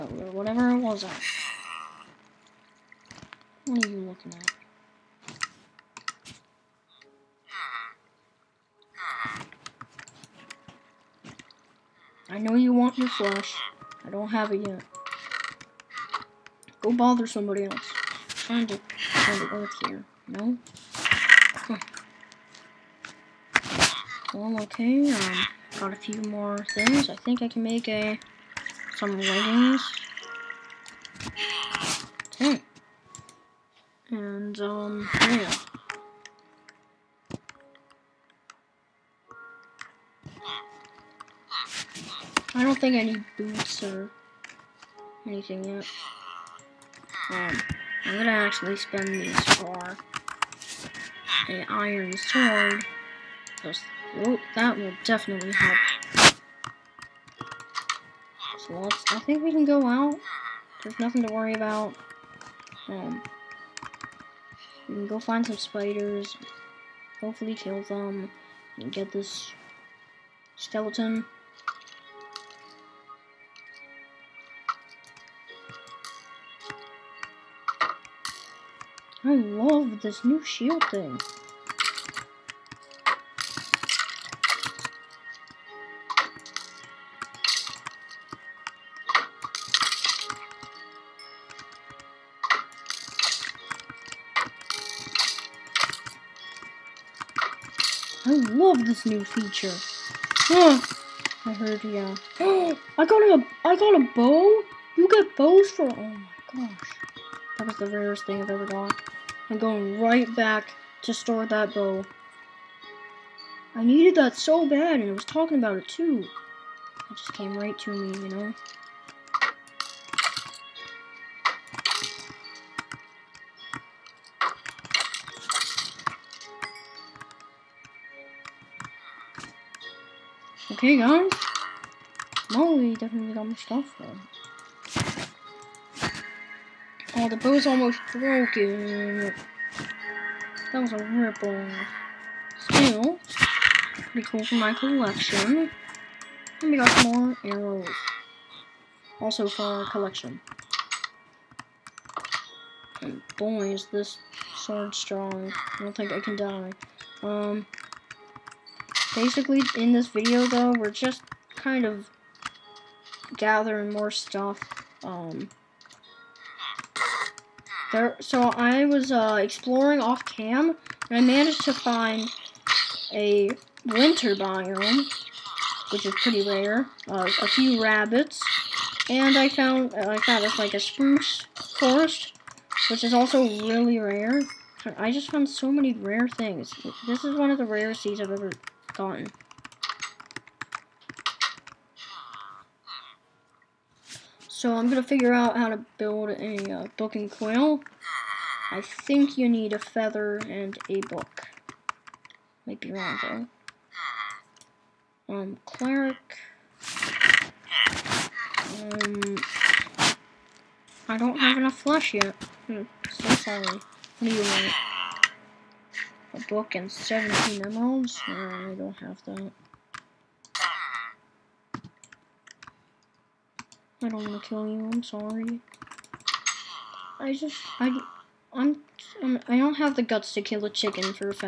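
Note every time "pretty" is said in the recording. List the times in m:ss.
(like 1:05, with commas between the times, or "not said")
2:24, 2:56.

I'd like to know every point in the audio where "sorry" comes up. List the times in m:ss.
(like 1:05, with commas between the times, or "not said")
3:33, 3:45.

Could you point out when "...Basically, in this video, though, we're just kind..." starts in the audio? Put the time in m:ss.
2:39.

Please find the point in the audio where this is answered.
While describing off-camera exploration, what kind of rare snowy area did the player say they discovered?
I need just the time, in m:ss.
2:53.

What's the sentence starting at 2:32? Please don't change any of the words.
And boy, is this sword strong.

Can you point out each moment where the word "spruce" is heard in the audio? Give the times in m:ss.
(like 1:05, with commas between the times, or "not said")
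3:00.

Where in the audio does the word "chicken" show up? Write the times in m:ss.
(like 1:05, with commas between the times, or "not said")
3:50.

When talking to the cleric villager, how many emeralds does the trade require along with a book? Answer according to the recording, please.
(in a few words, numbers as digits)
17.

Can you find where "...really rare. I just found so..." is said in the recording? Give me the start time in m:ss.
3:03.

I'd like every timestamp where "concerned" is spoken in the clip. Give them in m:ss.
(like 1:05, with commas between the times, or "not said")
not said.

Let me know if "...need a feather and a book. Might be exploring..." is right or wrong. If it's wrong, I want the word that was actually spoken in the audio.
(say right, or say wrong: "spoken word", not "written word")
wrong: "wrong", not "exploring".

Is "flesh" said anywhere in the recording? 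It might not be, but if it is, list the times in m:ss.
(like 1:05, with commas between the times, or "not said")
0:13, 3:31.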